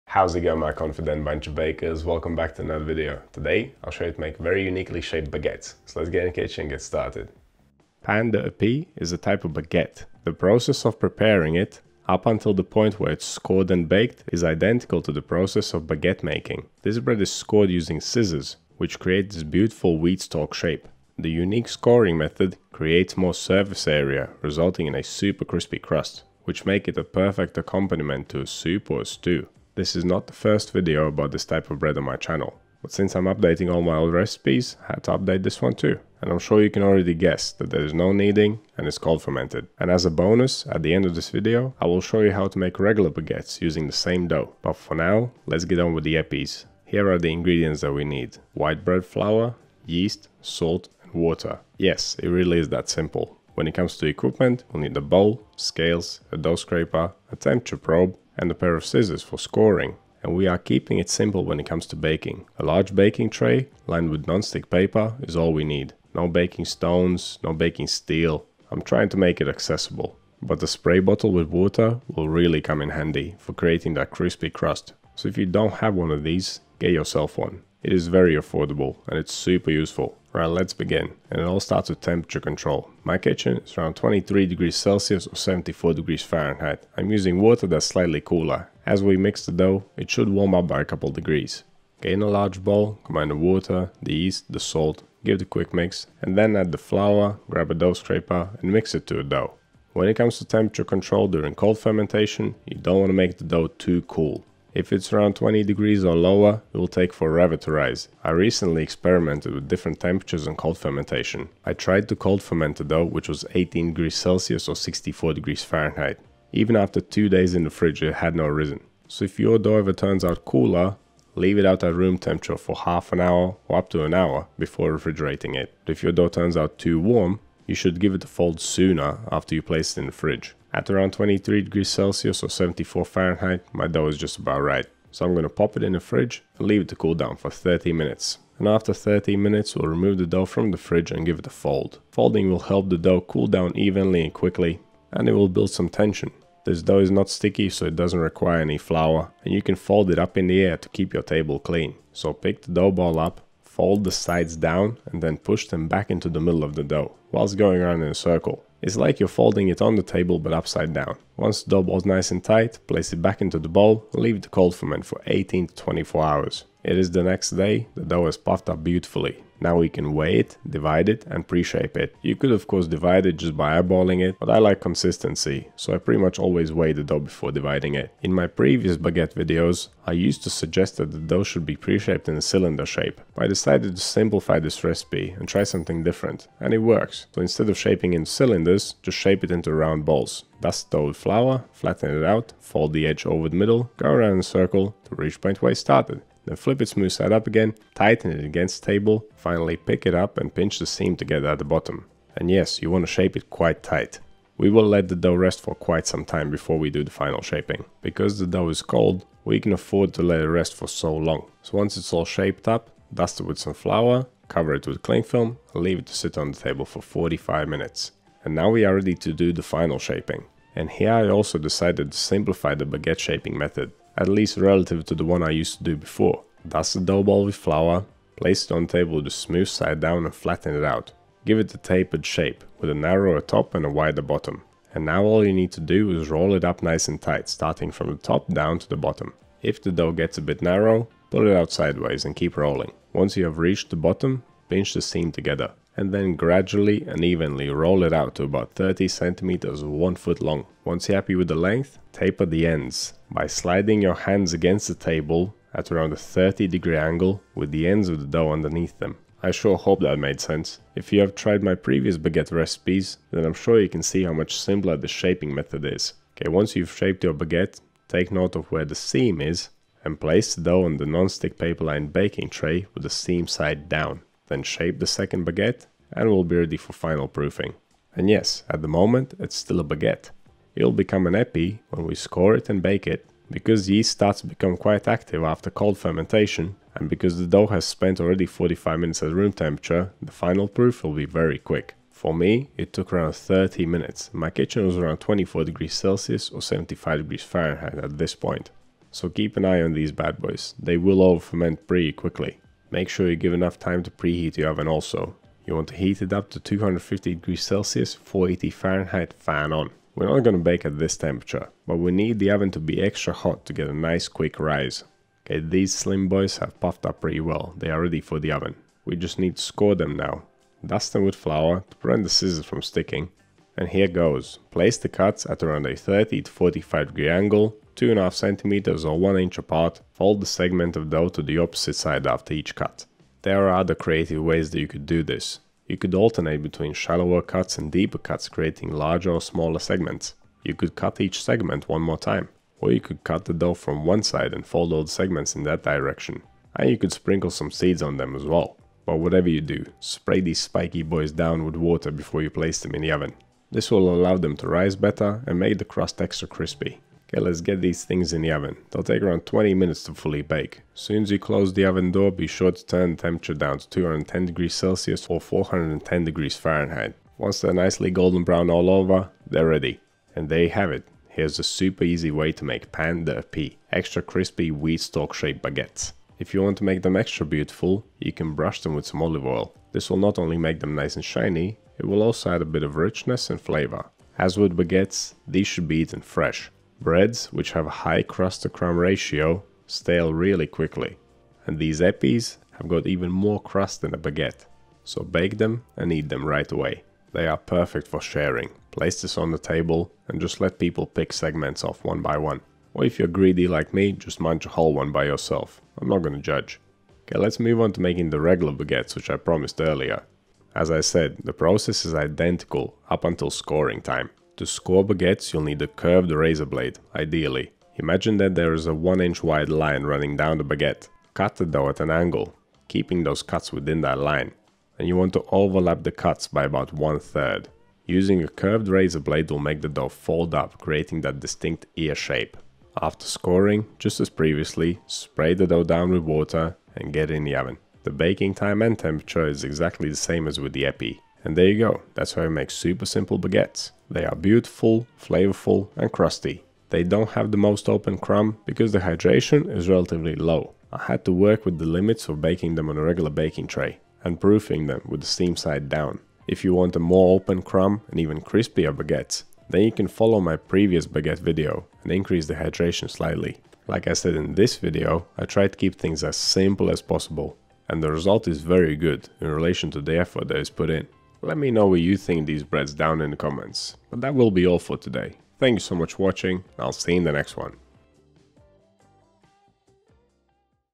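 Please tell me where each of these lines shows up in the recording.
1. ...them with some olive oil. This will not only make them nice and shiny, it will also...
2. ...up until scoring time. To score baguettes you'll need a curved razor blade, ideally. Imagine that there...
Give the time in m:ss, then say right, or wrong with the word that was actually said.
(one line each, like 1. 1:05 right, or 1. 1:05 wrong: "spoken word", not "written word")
1. 6:18 right
2. 6:53 right.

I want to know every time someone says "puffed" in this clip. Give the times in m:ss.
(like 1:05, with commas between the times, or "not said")
2:48, 5:16.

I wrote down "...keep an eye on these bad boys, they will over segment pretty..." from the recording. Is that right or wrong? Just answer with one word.
wrong.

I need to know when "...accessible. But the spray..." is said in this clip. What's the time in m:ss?
1:09.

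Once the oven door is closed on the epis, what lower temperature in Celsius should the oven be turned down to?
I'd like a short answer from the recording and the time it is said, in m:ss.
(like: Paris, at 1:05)
210 degrees Celsius, at 6:03.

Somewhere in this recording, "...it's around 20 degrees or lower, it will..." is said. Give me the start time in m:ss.
1:44.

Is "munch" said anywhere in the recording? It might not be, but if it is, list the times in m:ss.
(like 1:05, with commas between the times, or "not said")
6:44.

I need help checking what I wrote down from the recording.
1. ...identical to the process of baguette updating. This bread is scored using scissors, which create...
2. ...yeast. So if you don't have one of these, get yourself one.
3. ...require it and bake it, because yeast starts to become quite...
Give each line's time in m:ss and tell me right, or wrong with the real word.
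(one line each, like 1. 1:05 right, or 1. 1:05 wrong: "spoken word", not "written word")
1. 0:14 wrong: "making", not "updating"
2. 1:14 wrong: "crust", not "yeast"
3. 4:42 wrong: "score", not "require".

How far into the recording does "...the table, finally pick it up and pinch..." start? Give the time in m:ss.
3:18.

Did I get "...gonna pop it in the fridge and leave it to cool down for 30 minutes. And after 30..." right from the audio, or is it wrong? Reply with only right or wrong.
right.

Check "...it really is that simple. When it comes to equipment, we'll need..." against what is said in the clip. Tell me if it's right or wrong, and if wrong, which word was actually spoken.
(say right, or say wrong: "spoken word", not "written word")
right.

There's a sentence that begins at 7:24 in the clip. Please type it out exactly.
They are beautiful, flavorful and crusty.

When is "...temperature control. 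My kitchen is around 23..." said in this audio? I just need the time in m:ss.
1:21.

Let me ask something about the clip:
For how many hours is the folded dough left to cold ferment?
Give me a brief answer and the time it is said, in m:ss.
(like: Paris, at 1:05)
18 to 24 hours, at 2:45.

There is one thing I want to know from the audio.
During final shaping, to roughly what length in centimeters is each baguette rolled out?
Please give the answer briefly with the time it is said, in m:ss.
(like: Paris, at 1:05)
30 centimeters, at 4:08.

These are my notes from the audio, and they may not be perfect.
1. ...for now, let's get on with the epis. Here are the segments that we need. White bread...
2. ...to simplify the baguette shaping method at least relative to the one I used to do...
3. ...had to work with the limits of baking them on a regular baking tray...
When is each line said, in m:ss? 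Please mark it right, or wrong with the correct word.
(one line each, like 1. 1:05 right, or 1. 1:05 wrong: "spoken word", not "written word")
1. 0:44 wrong: "ingredients", not "segments"
2. 3:42 right
3. 7:31 right.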